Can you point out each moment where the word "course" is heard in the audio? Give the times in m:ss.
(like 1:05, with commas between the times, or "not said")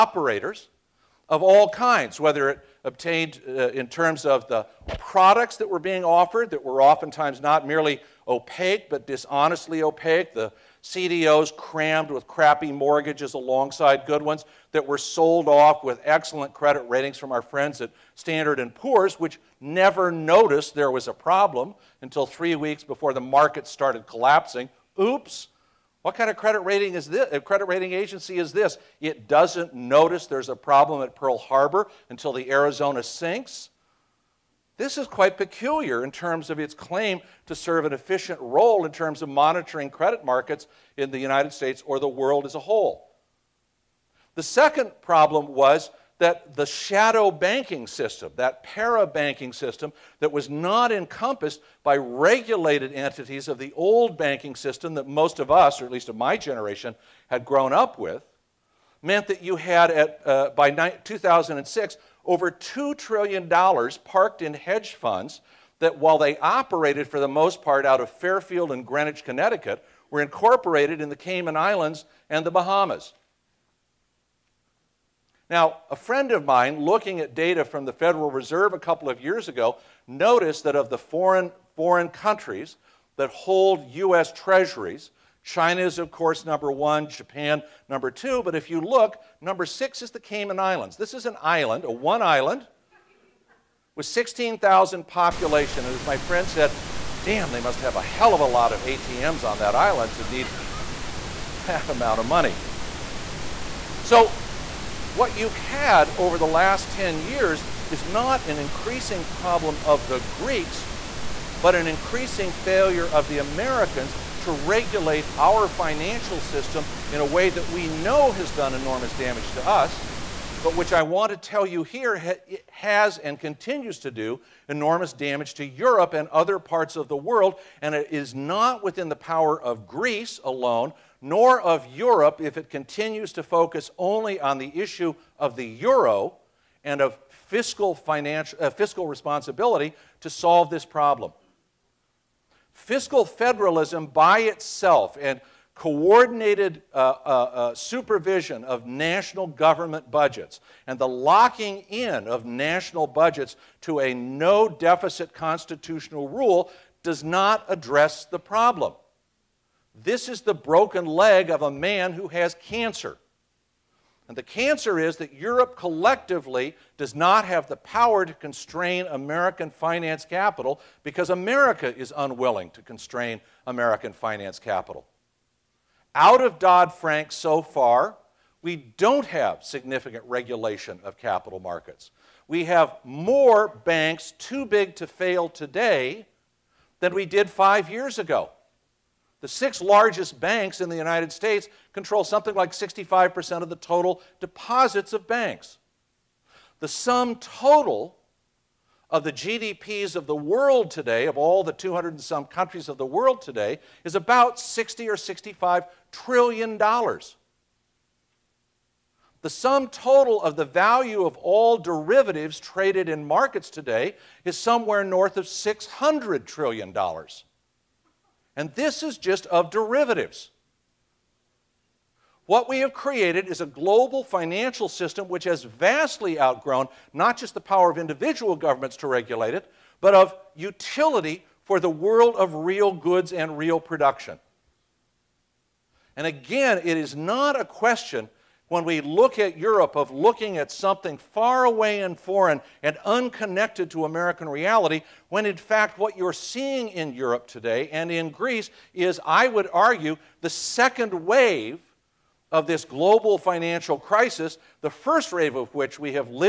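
1:26.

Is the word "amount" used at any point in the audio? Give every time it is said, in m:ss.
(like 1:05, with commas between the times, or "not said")
1:41.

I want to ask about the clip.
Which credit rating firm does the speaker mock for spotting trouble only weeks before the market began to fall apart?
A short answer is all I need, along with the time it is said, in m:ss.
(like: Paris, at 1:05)
Standard and Poor's, at 0:18.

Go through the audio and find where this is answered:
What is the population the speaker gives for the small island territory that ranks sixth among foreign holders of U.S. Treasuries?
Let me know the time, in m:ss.
1:34.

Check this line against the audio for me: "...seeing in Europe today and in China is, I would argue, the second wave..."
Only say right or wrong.
wrong.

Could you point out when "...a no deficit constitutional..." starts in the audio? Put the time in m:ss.
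2:33.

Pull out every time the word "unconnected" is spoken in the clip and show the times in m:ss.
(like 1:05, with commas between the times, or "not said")
4:03.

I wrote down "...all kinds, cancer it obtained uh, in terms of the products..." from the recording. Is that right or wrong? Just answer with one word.
wrong.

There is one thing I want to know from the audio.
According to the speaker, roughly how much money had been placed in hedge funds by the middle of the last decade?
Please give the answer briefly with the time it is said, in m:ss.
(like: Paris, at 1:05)
over $2 trillion, at 1:02.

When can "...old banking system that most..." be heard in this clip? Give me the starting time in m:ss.
0:53.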